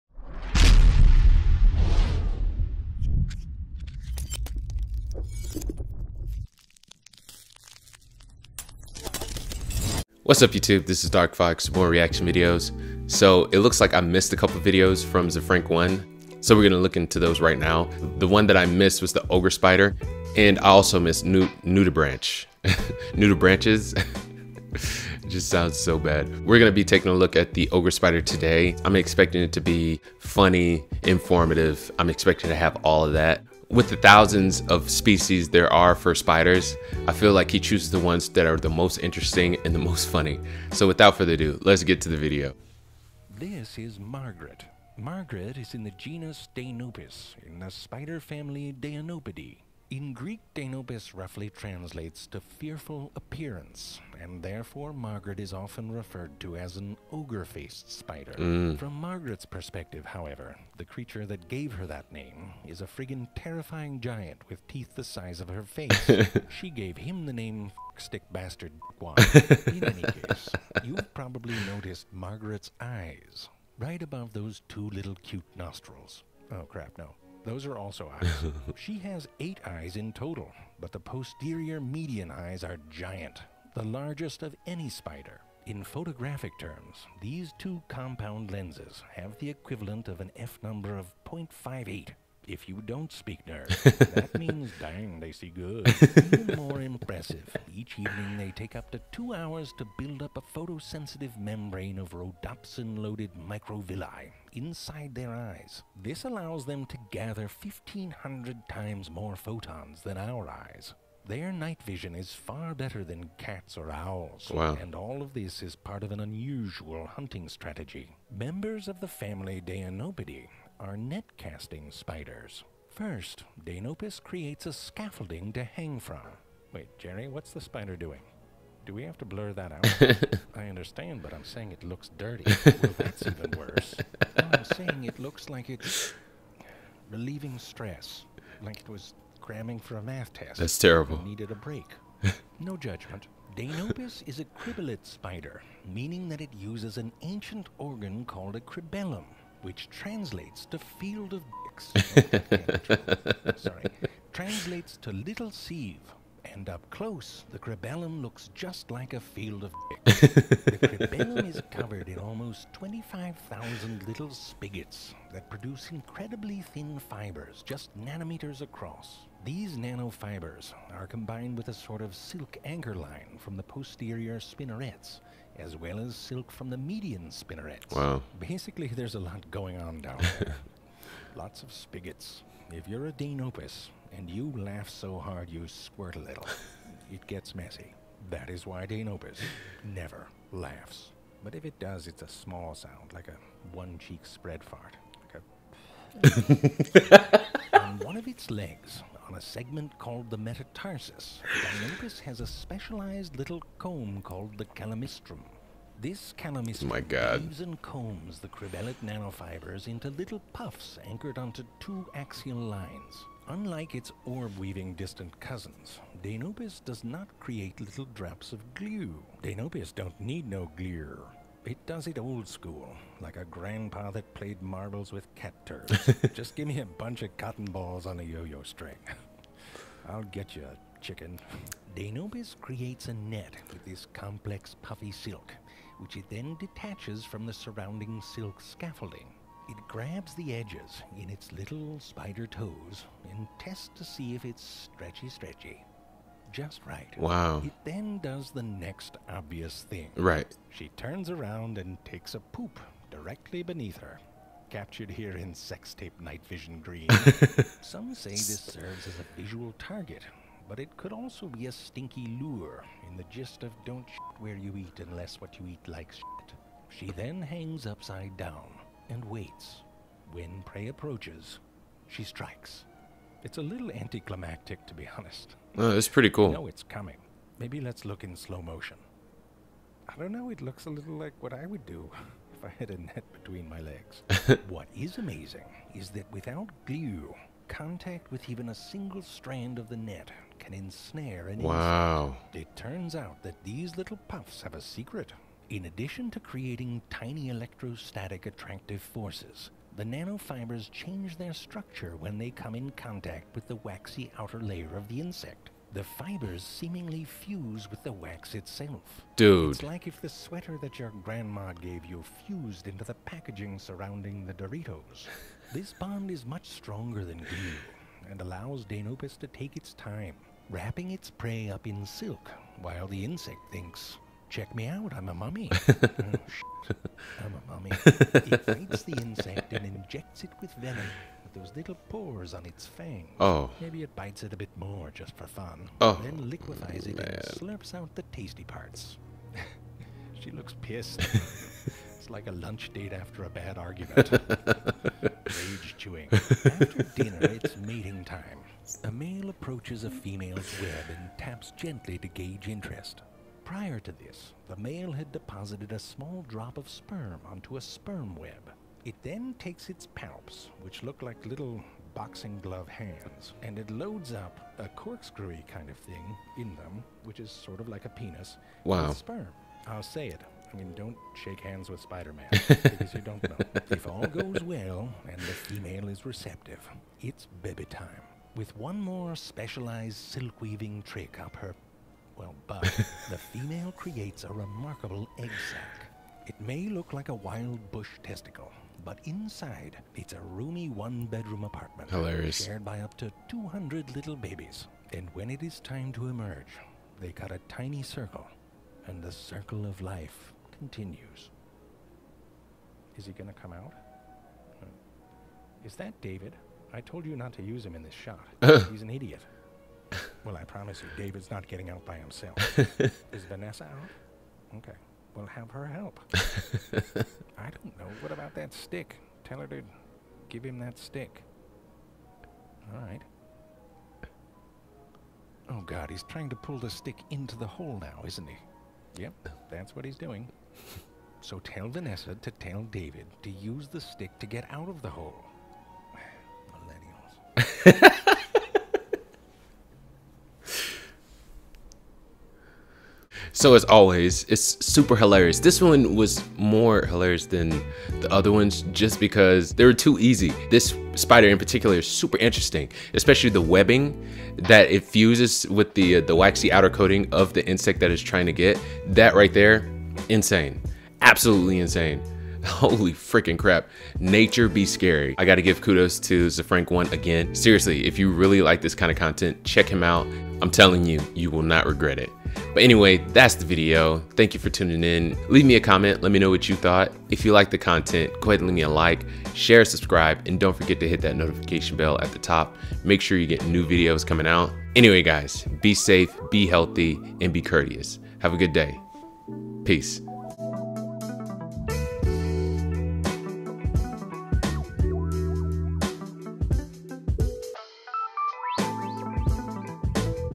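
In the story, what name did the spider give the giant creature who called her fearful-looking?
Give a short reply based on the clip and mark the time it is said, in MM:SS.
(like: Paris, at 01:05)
Stick Bastard Guan, at 01:07.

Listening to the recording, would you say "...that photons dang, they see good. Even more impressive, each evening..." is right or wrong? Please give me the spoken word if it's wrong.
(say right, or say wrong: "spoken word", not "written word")
wrong: "means", not "photons".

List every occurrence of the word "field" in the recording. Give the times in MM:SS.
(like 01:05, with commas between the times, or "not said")
02:30, 02:39.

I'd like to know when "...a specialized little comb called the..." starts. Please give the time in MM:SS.
03:22.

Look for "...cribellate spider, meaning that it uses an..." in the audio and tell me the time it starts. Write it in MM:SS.
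02:24.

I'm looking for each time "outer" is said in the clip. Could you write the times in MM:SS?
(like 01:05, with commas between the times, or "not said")
05:04, 07:36.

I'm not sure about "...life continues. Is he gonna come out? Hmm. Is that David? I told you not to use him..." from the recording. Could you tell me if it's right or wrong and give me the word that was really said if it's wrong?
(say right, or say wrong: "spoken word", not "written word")
right.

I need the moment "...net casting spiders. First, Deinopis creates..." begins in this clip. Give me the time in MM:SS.
02:00.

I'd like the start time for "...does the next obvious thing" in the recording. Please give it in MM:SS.
04:08.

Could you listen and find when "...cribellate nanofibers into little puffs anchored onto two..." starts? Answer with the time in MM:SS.
03:28.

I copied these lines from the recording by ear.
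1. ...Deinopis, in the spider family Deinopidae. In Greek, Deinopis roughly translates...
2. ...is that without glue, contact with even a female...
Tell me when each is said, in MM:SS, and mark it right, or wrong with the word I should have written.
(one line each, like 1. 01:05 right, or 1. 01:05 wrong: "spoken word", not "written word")
1. 00:46 right
2. 04:45 wrong: "single", not "female".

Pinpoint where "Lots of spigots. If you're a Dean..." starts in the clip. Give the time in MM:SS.
03:01.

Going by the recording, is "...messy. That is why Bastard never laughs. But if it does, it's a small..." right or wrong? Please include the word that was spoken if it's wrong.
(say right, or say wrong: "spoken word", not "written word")
wrong: "Dean", not "Bastard".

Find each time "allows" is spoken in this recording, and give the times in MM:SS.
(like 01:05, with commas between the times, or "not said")
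01:46, 05:18.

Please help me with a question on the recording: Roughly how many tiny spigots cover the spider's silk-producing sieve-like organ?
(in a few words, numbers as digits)
25,000.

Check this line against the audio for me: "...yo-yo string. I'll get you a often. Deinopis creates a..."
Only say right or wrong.
wrong.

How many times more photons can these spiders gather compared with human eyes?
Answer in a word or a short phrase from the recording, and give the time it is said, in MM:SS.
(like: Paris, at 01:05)
1,500, at 01:47.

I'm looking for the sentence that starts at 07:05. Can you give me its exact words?
Oh, God, he's trying to pull the stick into the hole now, isn't he?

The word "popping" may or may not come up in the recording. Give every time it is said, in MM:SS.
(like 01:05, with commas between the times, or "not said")
not said.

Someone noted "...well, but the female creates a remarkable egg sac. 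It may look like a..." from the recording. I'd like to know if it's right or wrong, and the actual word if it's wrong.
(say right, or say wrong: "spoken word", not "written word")
right.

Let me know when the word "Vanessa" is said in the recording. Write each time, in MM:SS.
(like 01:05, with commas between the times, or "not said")
06:53, 07:11.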